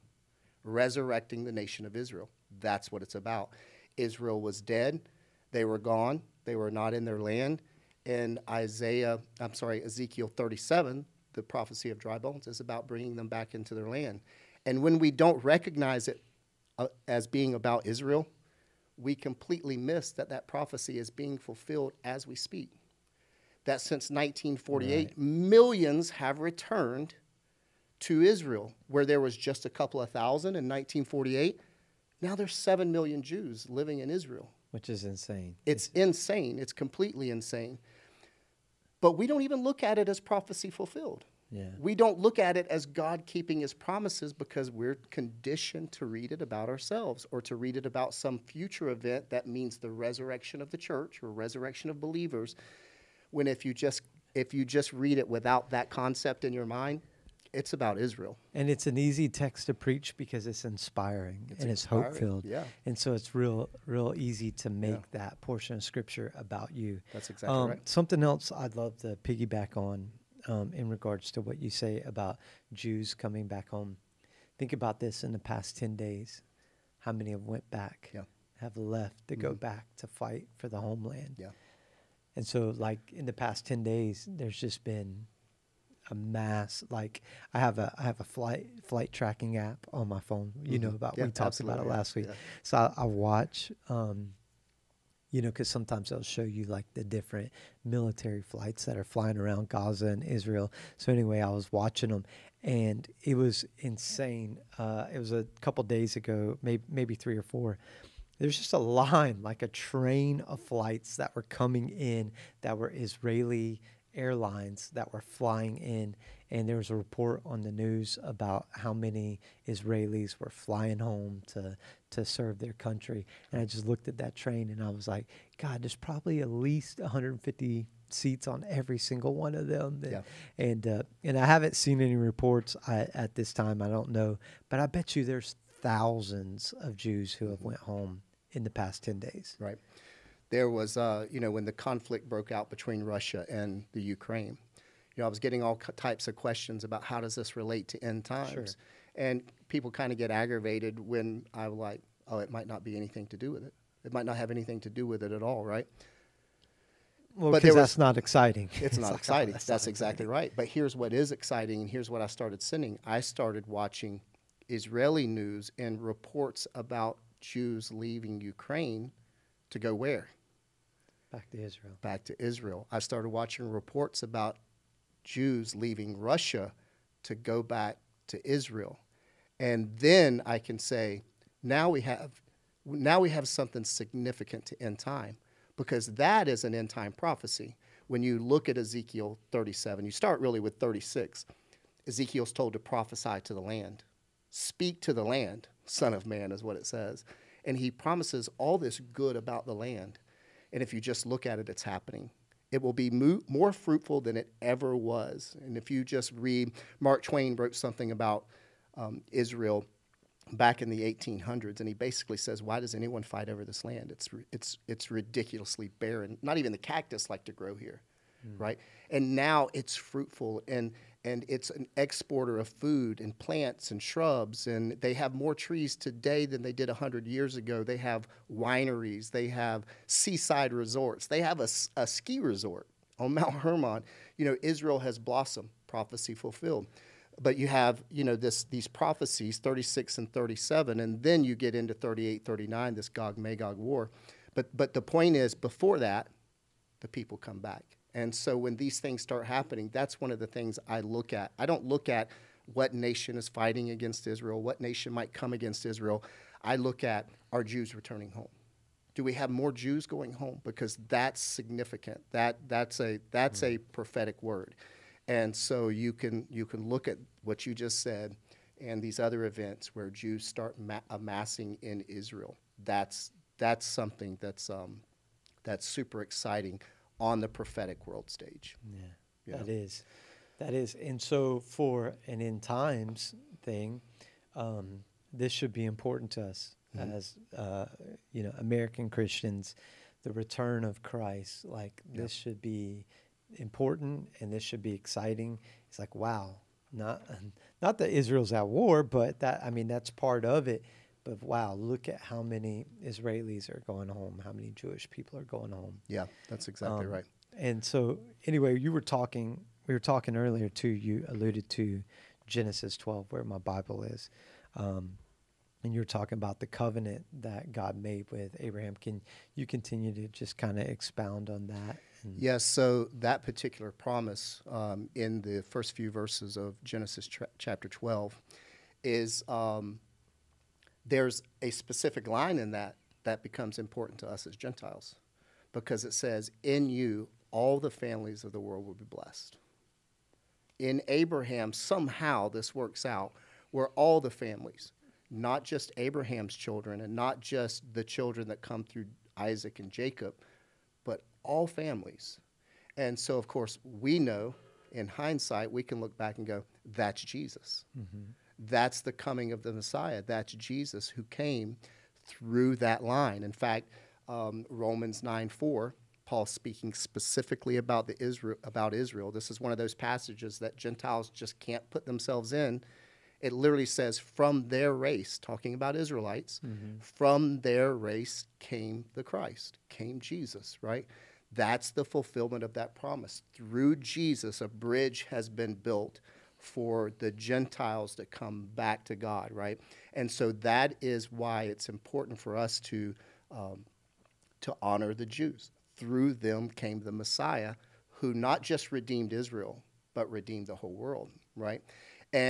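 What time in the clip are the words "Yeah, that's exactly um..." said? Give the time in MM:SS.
05:06.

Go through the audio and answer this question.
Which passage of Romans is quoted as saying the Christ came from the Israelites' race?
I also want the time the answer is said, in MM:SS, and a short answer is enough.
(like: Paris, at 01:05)
Romans 9:4, at 06:04.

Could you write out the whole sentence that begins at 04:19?
Do we have more Jews going home?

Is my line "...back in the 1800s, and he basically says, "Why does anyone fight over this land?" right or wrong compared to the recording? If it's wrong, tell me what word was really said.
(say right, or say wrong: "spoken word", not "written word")
right.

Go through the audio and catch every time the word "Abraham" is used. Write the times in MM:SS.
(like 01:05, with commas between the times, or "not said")
05:18, 05:41, 05:45.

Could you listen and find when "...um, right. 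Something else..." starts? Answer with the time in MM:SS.
01:07.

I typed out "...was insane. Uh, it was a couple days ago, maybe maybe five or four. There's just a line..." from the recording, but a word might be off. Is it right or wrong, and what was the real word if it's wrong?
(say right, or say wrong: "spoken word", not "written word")
wrong: "three", not "five".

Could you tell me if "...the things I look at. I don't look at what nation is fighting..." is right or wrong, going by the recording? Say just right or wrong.
right.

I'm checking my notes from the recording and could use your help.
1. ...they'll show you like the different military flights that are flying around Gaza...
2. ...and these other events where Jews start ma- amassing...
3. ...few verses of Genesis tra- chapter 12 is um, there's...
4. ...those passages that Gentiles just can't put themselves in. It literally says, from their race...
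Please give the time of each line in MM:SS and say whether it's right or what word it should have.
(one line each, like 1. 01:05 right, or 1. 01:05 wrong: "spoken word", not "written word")
1. 01:36 right
2. 04:28 right
3. 05:25 right
4. 06:09 right.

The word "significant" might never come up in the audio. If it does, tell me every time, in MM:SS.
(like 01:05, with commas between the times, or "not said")
03:03, 04:21.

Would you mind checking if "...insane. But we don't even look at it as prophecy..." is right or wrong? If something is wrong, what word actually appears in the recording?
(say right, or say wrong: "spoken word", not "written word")
right.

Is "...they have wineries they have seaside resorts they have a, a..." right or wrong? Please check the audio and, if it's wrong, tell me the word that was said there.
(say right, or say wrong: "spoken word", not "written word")
right.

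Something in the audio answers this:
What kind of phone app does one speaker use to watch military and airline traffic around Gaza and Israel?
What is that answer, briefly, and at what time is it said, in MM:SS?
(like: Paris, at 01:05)
flight tracking app, at 01:28.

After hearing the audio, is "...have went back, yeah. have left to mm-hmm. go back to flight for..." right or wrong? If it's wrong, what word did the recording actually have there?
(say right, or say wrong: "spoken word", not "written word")
wrong: "fight", not "flight".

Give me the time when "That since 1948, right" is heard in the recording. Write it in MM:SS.
00:23.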